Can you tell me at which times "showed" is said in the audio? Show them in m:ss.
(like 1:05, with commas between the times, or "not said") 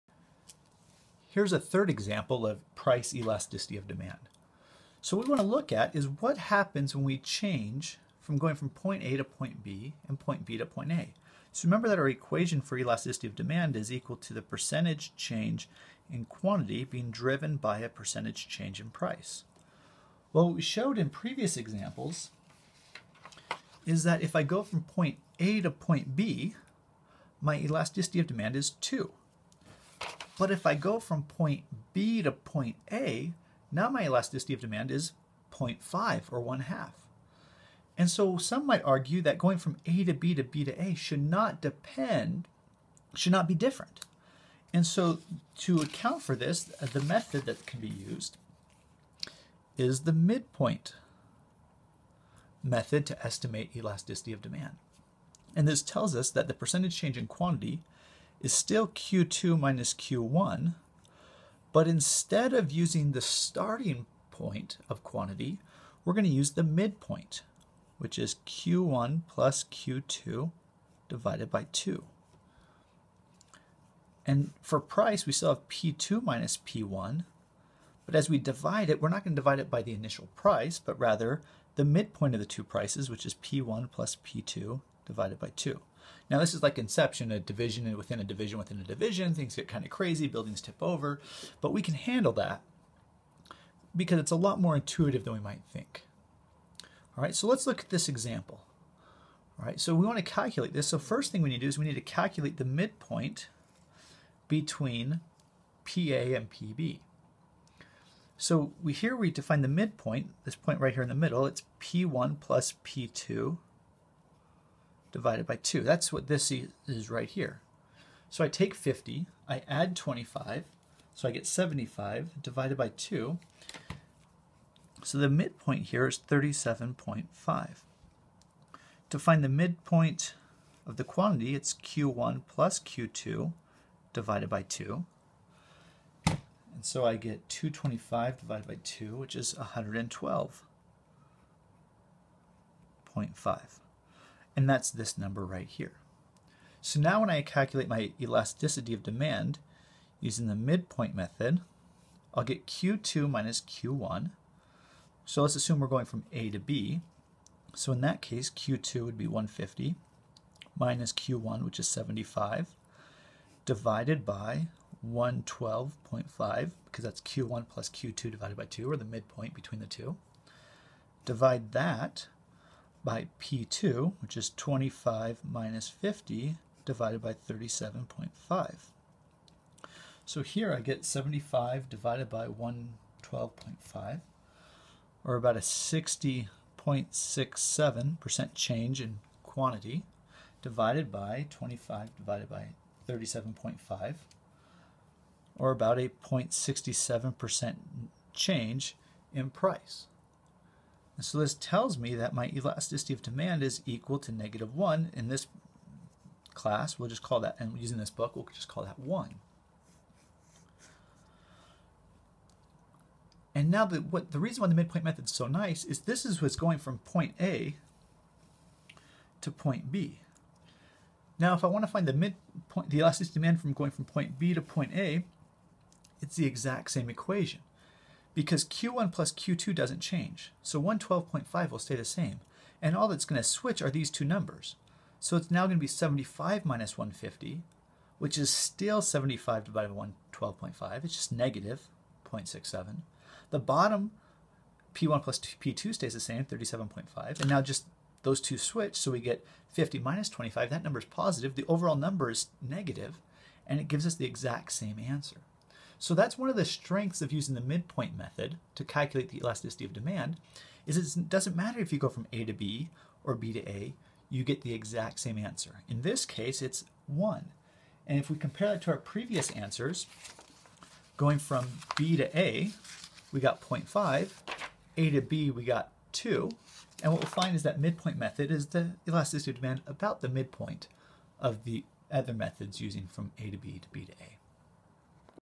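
0:20.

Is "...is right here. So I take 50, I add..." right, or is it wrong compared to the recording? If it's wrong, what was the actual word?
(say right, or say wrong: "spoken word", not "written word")
right.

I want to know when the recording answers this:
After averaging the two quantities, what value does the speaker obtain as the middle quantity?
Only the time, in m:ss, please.
2:19.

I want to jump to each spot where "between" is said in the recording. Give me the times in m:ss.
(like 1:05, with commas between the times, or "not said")
1:44, 2:49.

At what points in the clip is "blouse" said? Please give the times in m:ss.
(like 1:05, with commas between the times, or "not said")
not said.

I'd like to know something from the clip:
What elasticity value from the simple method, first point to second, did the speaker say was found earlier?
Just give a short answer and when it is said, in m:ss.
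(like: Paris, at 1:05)
2, at 0:27.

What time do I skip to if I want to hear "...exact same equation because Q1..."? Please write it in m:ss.
3:46.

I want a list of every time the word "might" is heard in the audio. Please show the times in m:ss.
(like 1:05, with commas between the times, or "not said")
0:38, 1:35.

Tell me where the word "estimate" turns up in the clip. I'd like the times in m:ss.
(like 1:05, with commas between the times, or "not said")
0:53.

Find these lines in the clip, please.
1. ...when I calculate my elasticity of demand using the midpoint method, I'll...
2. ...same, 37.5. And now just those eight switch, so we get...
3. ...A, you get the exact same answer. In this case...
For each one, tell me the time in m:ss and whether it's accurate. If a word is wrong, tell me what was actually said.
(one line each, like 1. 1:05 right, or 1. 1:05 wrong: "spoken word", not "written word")
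1. 2:27 right
2. 4:06 wrong: "two", not "eight"
3. 4:23 right.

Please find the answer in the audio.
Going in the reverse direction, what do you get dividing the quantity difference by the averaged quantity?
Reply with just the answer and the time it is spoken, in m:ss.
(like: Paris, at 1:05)
-0.67, at 4:01.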